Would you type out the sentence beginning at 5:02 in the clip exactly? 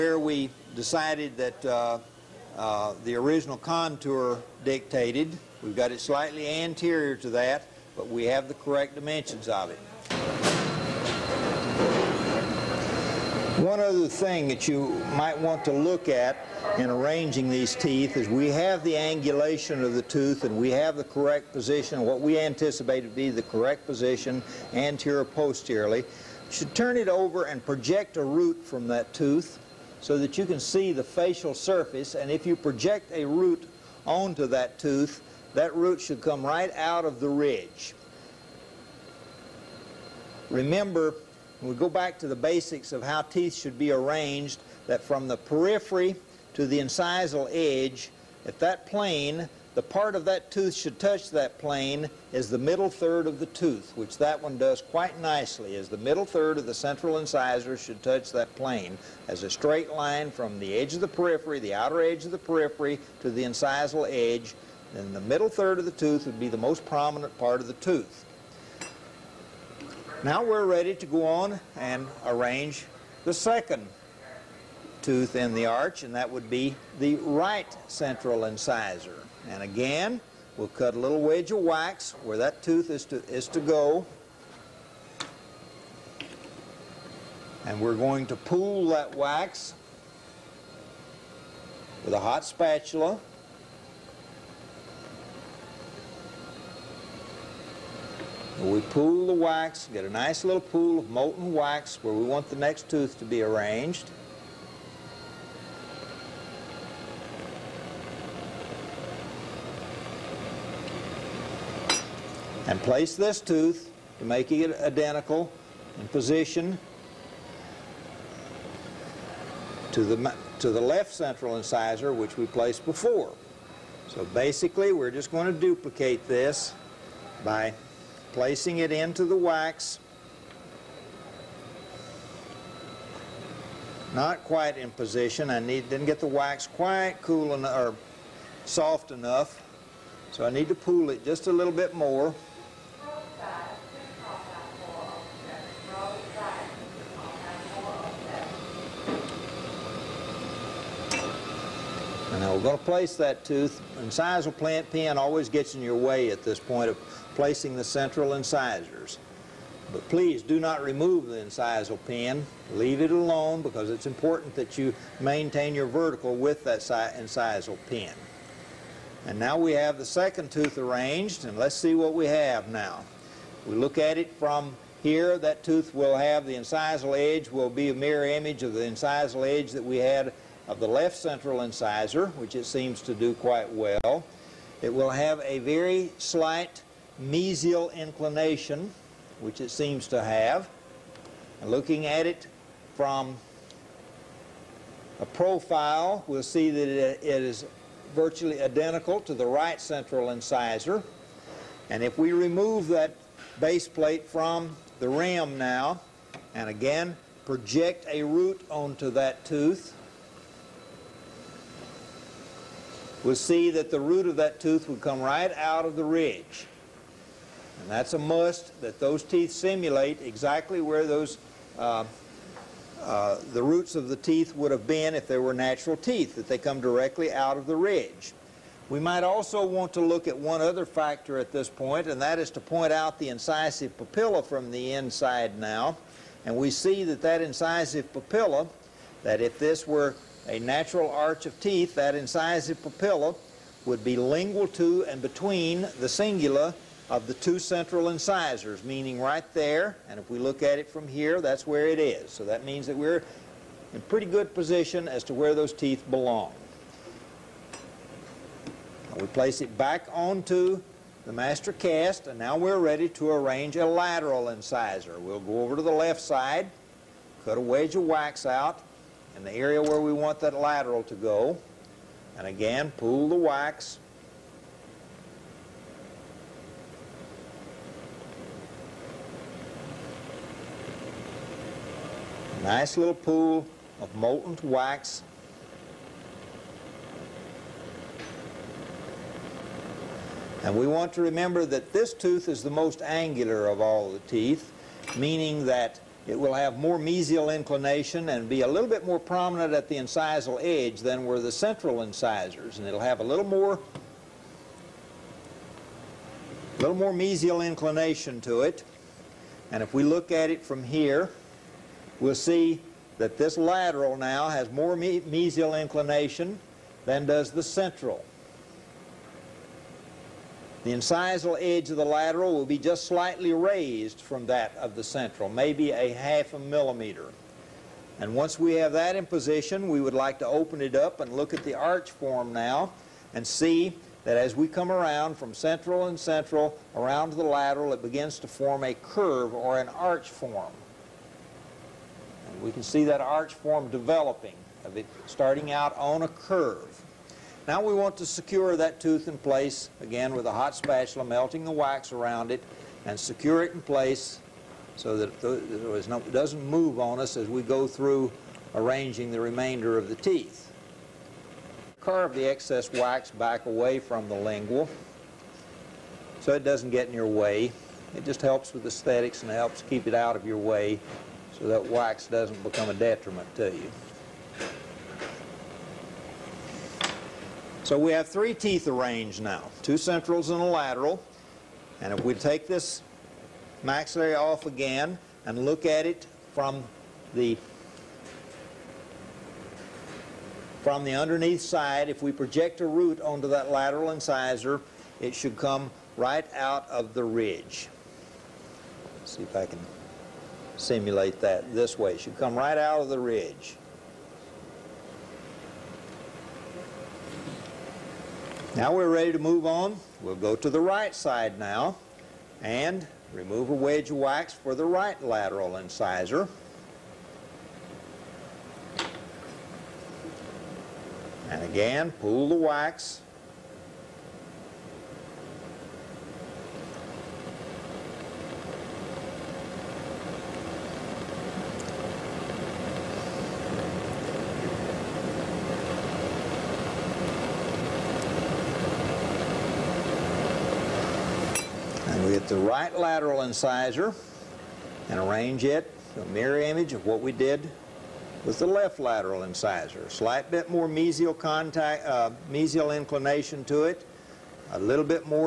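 And it'll have a little more, a little more mesial inclination to it.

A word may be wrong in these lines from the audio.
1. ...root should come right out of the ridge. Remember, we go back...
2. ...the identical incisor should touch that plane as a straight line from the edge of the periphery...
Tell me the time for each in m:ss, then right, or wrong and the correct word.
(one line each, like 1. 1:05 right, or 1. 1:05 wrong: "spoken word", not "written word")
1. 0:35 right
2. 0:56 wrong: "central", not "identical".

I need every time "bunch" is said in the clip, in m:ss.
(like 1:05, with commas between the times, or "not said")
not said.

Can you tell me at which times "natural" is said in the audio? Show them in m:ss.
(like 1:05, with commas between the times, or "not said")
3:45, 4:00.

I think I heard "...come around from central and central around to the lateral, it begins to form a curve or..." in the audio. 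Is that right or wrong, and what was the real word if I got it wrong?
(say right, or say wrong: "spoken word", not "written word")
right.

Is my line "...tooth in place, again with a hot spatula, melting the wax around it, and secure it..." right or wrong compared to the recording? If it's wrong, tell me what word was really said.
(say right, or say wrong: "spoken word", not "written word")
right.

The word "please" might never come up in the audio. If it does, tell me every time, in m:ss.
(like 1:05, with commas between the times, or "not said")
2:40.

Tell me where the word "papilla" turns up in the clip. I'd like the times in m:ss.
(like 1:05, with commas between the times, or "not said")
3:53, 3:58, 4:02.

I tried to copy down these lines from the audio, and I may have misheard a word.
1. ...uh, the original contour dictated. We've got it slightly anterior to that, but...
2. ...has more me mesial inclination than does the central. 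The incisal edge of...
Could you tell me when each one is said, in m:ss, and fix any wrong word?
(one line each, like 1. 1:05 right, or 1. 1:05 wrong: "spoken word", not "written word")
1. 0:02 right
2. 5:14 right.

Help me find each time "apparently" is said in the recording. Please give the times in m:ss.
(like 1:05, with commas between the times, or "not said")
not said.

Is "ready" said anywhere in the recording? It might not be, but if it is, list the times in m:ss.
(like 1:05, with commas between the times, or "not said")
1:10, 4:22, 6:49.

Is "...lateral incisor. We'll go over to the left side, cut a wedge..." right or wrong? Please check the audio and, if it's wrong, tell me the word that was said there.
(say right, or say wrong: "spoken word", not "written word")
right.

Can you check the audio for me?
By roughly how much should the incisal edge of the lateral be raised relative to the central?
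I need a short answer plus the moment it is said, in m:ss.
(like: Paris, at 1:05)
Half a millimeter, at 5:25.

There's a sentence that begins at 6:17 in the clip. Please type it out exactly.
So we have three teeth arranged now, two centrals and a lateral.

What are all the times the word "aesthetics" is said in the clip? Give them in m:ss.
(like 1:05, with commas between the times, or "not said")
6:08.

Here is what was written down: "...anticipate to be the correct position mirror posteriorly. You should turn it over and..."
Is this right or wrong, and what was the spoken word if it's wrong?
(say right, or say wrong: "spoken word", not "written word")
wrong: "anterior", not "mirror".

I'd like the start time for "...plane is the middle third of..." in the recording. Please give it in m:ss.
0:51.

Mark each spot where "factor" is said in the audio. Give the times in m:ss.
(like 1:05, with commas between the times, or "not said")
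3:50.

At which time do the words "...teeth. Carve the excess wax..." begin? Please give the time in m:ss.
6:00.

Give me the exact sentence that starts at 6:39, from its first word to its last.
Let's see if I can simulate that this way.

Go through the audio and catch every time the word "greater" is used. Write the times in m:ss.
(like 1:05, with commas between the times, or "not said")
not said.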